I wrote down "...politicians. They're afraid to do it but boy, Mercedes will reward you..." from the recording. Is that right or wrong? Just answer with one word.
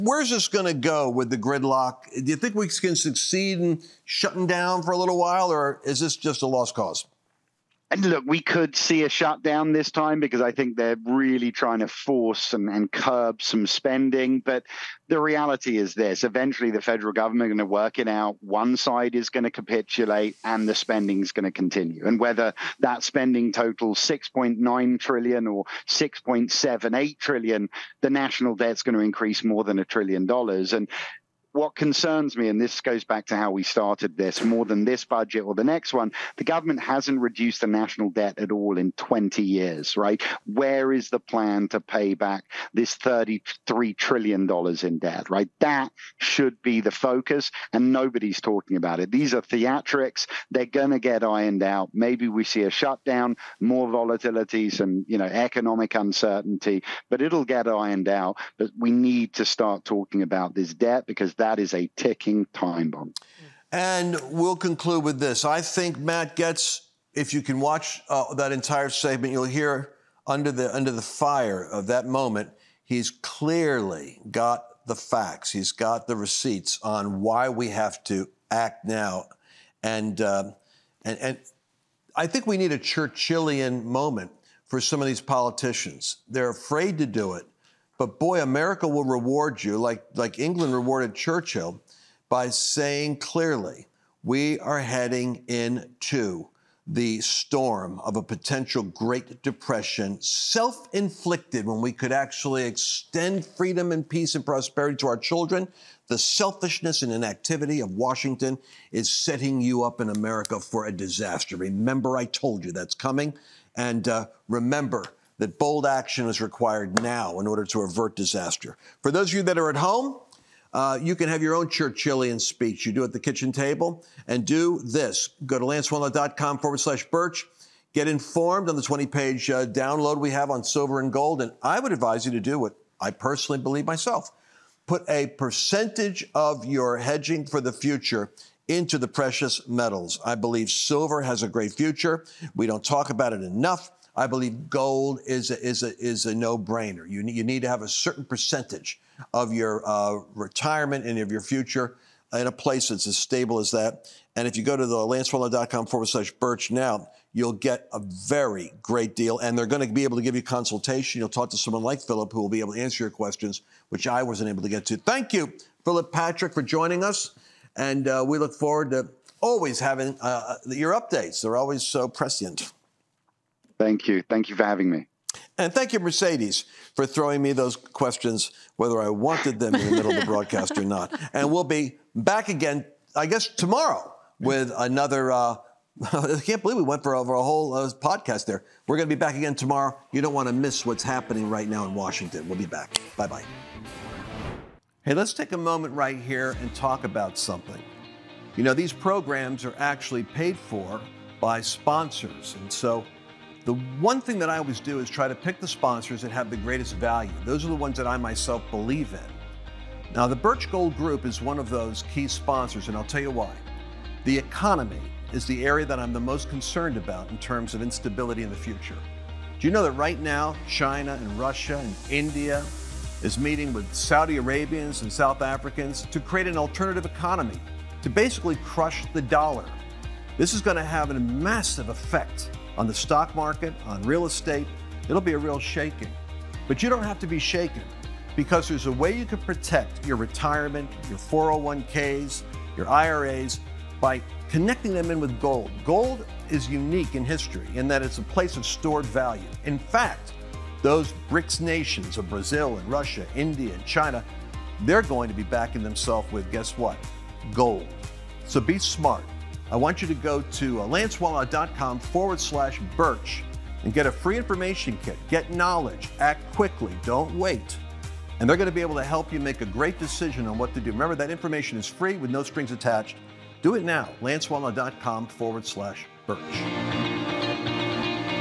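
wrong.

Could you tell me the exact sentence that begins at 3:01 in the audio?
And we'll be back again, I guess, tomorrow with another.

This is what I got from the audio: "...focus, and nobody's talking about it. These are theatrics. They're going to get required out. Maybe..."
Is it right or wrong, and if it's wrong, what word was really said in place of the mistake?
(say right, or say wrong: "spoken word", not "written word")
wrong: "ironed", not "required".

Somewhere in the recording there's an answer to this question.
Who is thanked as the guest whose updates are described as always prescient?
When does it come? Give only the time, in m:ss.
2:45.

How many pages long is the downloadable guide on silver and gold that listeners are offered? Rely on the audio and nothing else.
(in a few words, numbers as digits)
20.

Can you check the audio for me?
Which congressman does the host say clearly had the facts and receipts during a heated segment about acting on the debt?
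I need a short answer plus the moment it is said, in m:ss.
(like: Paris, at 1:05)
Matt Gaetz, at 1:05.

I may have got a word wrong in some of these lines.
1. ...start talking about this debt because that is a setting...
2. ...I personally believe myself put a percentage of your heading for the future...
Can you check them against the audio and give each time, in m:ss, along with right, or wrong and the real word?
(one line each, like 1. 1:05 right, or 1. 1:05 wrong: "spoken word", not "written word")
1. 0:59 wrong: "ticking", not "setting"
2. 2:12 wrong: "hedging", not "heading".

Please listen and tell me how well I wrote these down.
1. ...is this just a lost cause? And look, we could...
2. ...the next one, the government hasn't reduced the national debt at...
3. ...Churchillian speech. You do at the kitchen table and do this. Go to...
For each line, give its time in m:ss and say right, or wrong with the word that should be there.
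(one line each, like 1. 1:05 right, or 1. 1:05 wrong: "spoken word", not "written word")
1. 0:05 right
2. 0:35 right
3. 2:01 right.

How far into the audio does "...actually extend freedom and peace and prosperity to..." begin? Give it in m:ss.
1:42.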